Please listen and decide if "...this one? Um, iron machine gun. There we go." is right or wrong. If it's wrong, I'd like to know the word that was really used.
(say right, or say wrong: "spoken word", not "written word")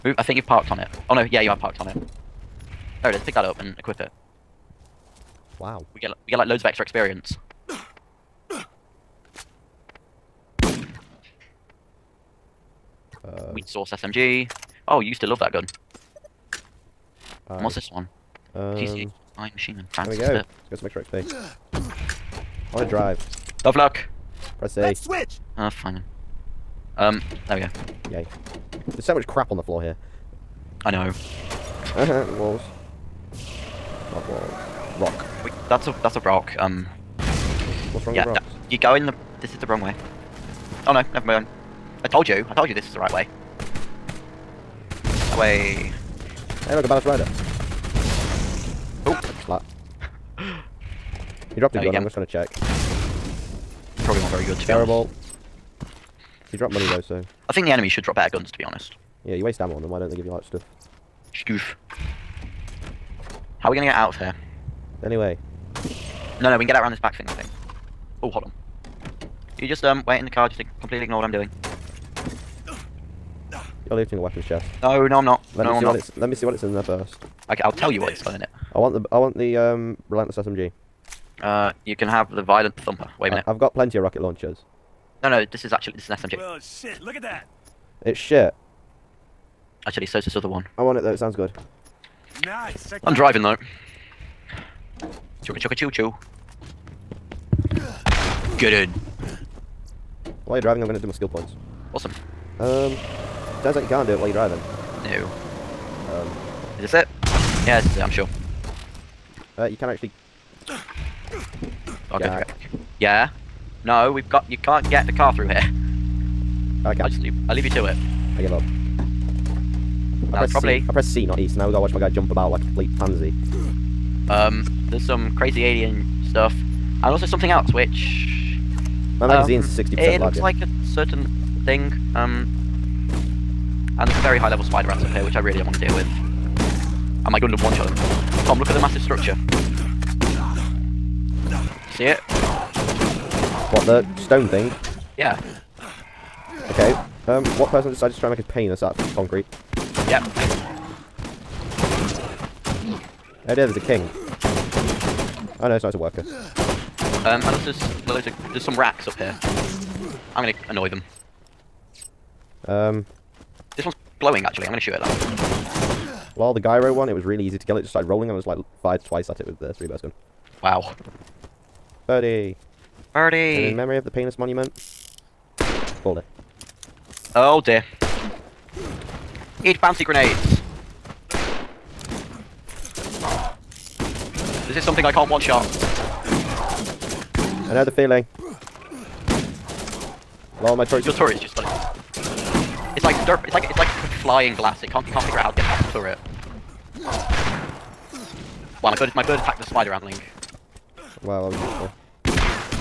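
right.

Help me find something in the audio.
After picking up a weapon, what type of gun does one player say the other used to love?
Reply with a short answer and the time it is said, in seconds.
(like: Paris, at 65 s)
Wheat source SMG, at 13 s.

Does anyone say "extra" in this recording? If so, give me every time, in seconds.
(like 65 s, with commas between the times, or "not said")
6 s, 20 s.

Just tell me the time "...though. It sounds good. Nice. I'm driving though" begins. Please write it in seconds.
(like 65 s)
91 s.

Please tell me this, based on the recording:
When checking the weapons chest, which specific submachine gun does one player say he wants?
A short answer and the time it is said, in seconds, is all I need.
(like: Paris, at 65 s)
relentless SMG, at 80 s.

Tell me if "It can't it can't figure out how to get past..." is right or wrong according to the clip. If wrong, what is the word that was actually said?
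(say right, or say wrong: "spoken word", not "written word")
right.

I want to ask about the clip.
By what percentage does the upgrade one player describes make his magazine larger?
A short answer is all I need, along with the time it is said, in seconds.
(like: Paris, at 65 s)
60%, at 129 s.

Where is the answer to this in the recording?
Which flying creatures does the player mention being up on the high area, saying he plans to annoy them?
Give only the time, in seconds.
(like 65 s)
158 s.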